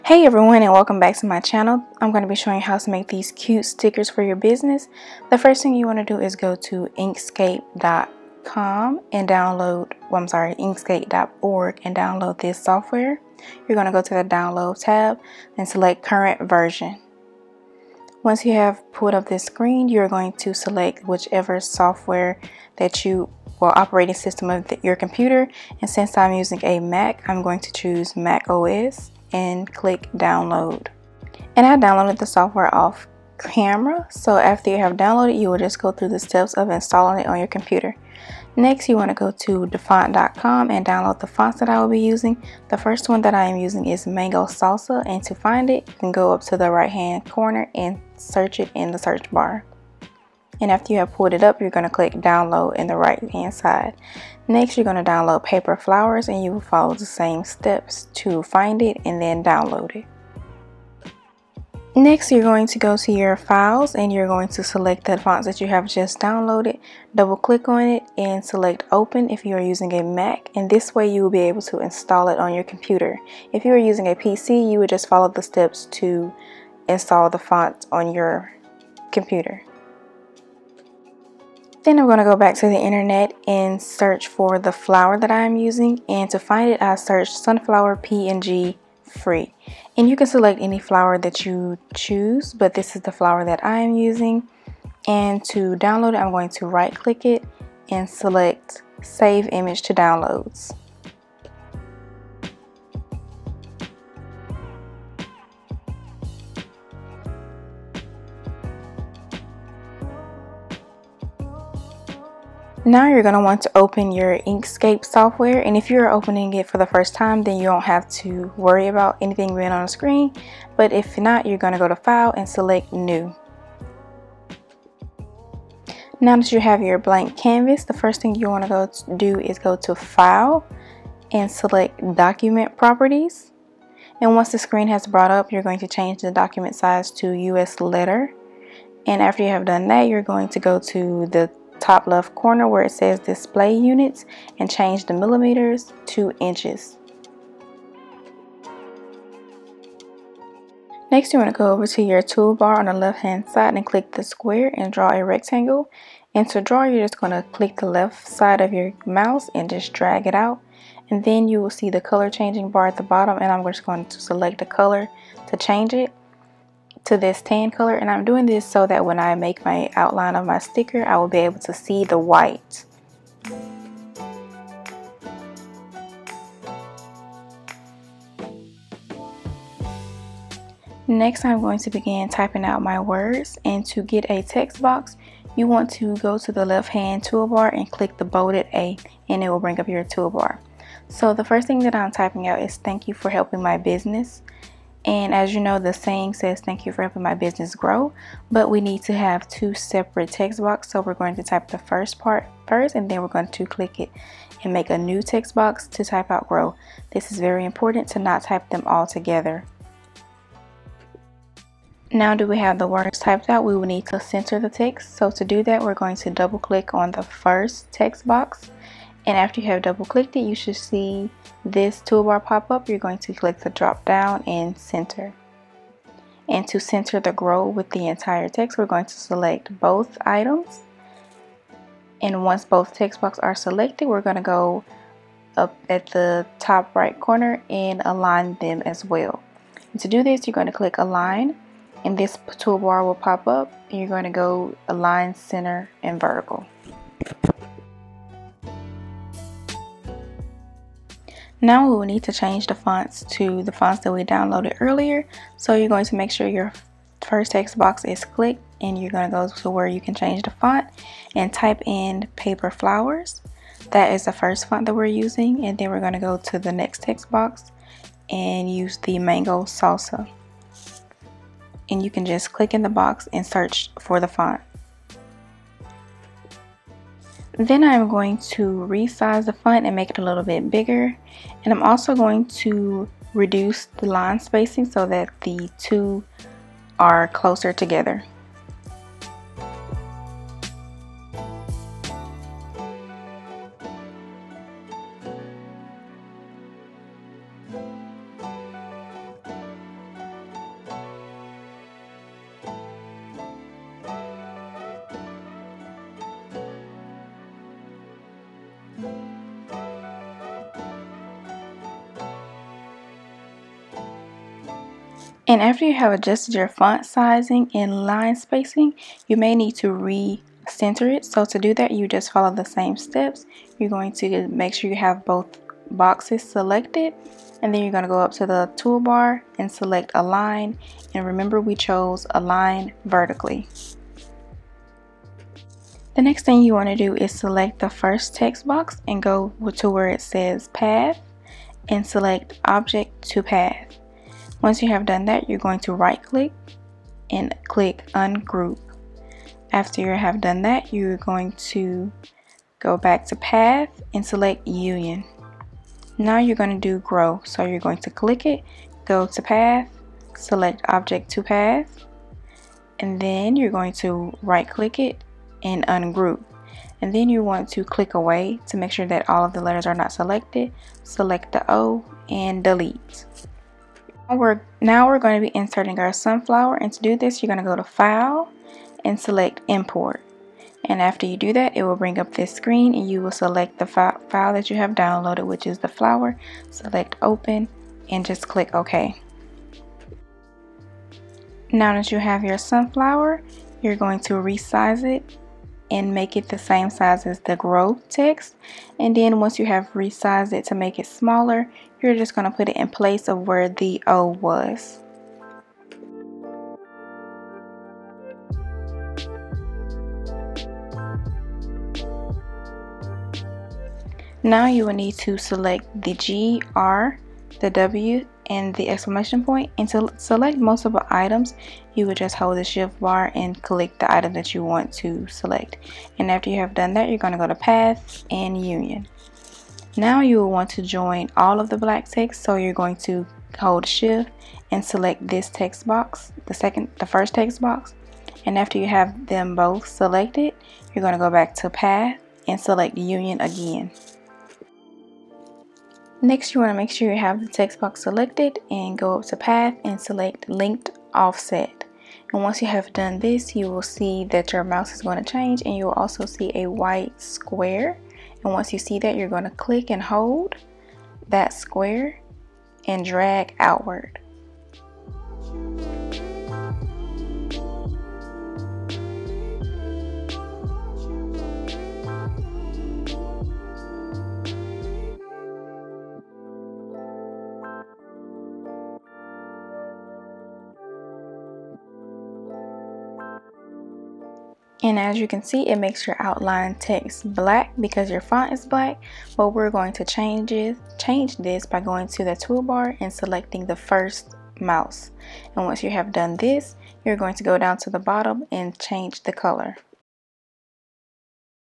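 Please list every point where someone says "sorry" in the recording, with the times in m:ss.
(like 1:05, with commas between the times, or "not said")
0:10.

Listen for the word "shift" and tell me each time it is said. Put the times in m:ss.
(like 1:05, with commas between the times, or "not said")
7:02, 7:13.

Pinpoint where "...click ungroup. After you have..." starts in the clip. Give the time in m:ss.
5:47.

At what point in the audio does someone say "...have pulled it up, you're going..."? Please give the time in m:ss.
0:51.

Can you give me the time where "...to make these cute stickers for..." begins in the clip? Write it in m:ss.
0:02.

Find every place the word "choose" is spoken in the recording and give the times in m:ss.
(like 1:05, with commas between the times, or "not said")
0:27, 1:31.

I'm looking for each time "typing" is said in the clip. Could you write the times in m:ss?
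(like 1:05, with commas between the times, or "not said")
3:02, 3:12.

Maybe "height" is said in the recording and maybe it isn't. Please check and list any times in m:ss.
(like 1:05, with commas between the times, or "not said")
not said.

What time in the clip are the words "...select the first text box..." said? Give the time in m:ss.
5:37.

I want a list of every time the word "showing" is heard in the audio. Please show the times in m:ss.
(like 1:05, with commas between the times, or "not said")
0:02.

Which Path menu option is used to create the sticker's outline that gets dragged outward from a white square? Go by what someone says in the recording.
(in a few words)
linked offset.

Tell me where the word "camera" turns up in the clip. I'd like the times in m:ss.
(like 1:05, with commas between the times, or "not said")
0:33.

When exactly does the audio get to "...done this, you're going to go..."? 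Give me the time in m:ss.
8:16.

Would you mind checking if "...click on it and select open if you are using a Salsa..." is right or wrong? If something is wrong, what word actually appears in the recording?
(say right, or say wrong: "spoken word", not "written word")
wrong: "Mac", not "Salsa".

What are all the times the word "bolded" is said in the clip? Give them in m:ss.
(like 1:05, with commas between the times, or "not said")
3:08.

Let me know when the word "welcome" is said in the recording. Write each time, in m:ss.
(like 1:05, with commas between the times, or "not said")
0:00.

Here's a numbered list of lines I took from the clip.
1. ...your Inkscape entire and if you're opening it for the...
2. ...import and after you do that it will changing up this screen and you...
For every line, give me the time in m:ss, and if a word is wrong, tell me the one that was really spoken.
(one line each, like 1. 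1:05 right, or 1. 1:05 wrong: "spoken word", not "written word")
1. 1:54 wrong: "software", not "entire"
2. 6:19 wrong: "bring", not "changing".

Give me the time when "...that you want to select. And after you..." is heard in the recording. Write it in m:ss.
7:04.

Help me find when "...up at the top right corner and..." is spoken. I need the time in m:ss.
3:55.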